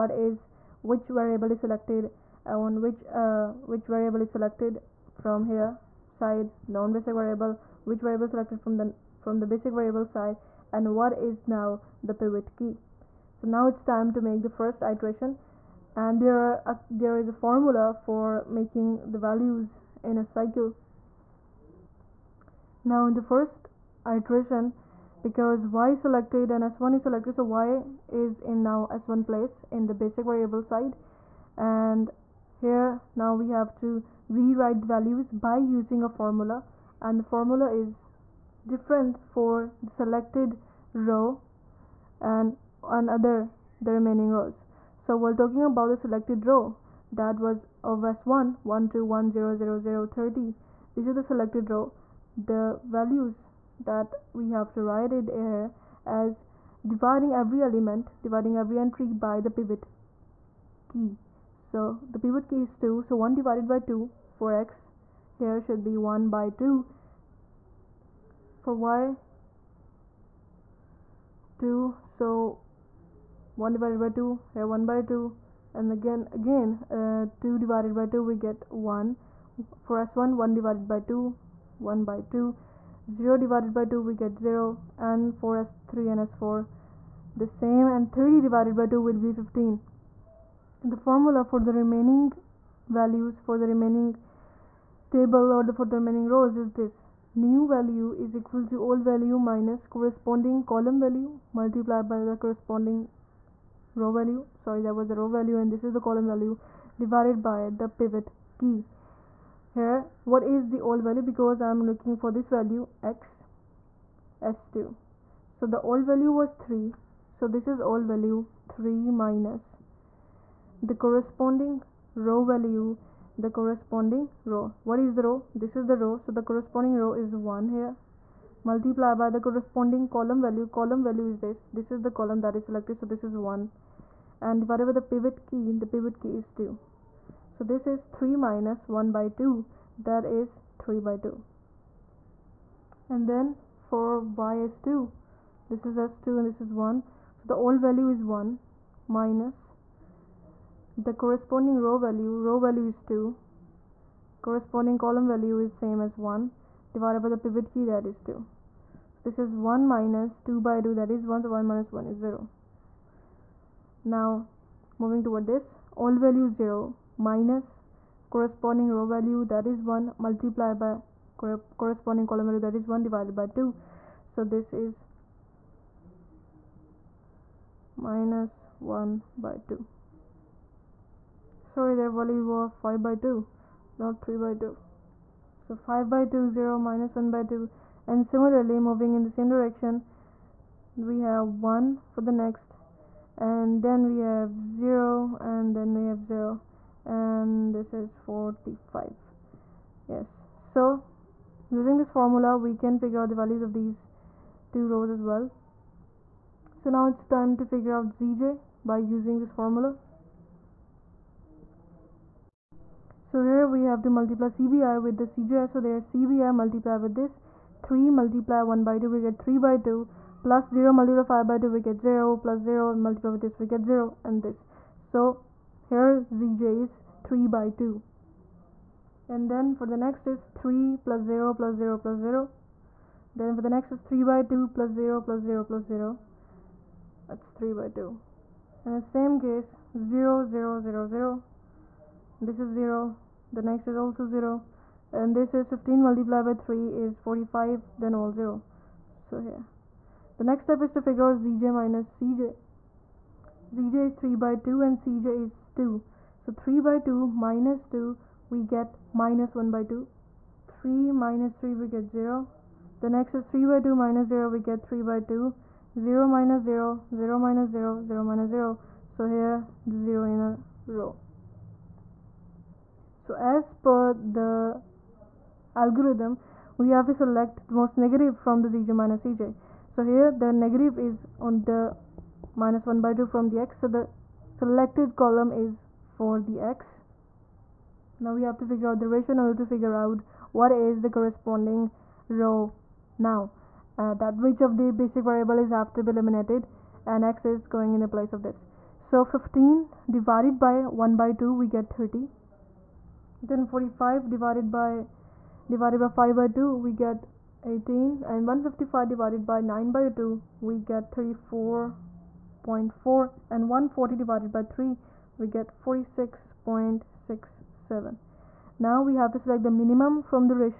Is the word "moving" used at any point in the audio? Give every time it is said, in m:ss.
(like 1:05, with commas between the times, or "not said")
2:44, 3:08.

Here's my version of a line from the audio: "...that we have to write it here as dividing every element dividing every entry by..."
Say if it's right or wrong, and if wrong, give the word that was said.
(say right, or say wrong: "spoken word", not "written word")
right.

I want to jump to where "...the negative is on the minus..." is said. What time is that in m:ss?
4:40.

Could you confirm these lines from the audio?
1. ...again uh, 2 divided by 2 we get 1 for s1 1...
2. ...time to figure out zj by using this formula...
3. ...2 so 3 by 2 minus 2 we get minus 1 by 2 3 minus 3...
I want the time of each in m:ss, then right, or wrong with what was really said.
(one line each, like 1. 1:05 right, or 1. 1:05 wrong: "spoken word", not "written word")
1. 1:16 right
2. 3:27 right
3. 4:15 right.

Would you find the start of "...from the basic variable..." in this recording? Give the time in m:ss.
0:09.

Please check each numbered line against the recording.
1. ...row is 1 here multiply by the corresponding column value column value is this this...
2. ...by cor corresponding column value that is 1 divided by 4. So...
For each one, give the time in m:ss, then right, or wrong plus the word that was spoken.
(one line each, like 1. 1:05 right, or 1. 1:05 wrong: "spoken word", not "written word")
1. 2:07 right
2. 2:50 wrong: "2", not "4".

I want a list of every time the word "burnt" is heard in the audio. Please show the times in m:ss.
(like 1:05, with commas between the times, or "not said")
not said.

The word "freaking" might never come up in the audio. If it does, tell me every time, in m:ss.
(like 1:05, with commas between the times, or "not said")
not said.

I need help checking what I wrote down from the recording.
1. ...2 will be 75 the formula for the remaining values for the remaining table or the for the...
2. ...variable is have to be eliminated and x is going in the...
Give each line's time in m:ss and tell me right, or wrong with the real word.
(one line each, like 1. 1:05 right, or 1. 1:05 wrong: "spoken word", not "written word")
1. 1:28 wrong: "15", not "75"
2. 4:55 right.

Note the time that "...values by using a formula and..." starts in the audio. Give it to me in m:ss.
0:34.